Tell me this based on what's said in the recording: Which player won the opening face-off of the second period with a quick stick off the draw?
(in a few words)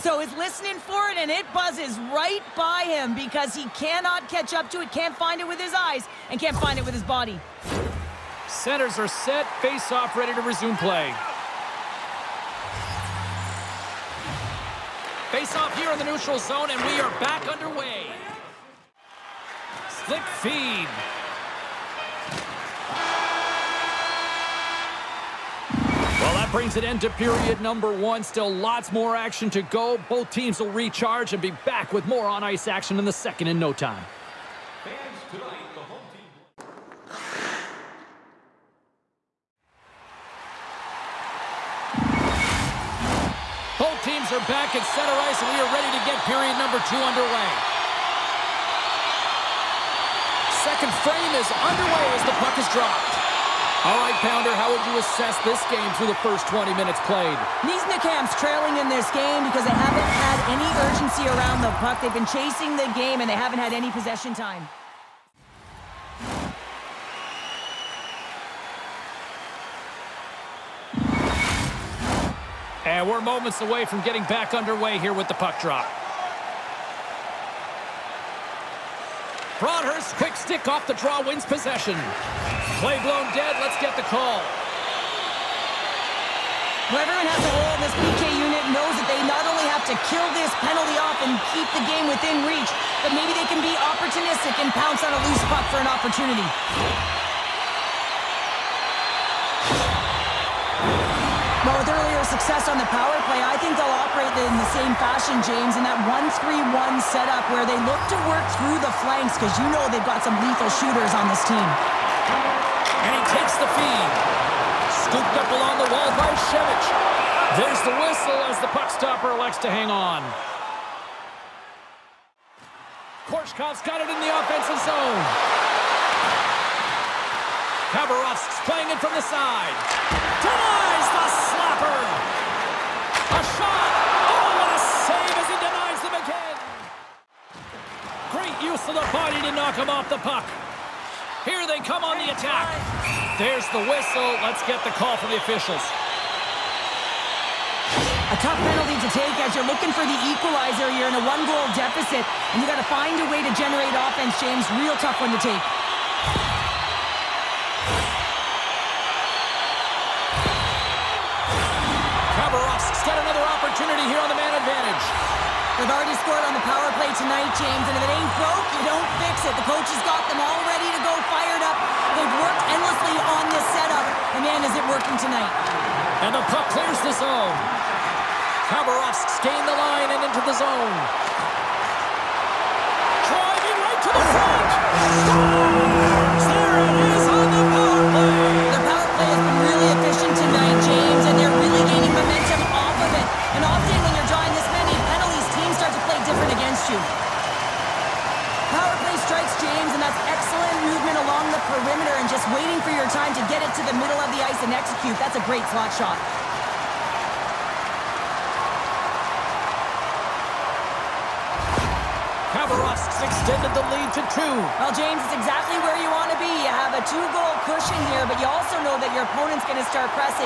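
Broadhurst.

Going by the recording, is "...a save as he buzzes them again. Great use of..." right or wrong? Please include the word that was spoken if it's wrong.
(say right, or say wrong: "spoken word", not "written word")
wrong: "denies", not "buzzes".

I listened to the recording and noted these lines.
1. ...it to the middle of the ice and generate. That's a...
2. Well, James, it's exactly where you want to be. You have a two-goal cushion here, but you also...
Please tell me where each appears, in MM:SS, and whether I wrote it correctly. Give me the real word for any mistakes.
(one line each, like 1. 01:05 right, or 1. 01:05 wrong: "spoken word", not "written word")
1. 03:23 wrong: "execute", not "generate"
2. 03:34 right.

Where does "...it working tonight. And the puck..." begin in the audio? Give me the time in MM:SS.
02:54.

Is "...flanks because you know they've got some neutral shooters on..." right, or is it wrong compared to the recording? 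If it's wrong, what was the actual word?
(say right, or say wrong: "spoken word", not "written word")
wrong: "lethal", not "neutral".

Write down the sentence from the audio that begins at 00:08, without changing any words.
Centers are set, face-off ready to resume play.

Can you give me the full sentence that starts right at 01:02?
They've been chasing the game, and they haven't had any possession time.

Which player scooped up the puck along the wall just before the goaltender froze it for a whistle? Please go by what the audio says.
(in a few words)
Shevich.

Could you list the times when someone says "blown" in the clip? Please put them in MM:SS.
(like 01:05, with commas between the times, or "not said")
01:23.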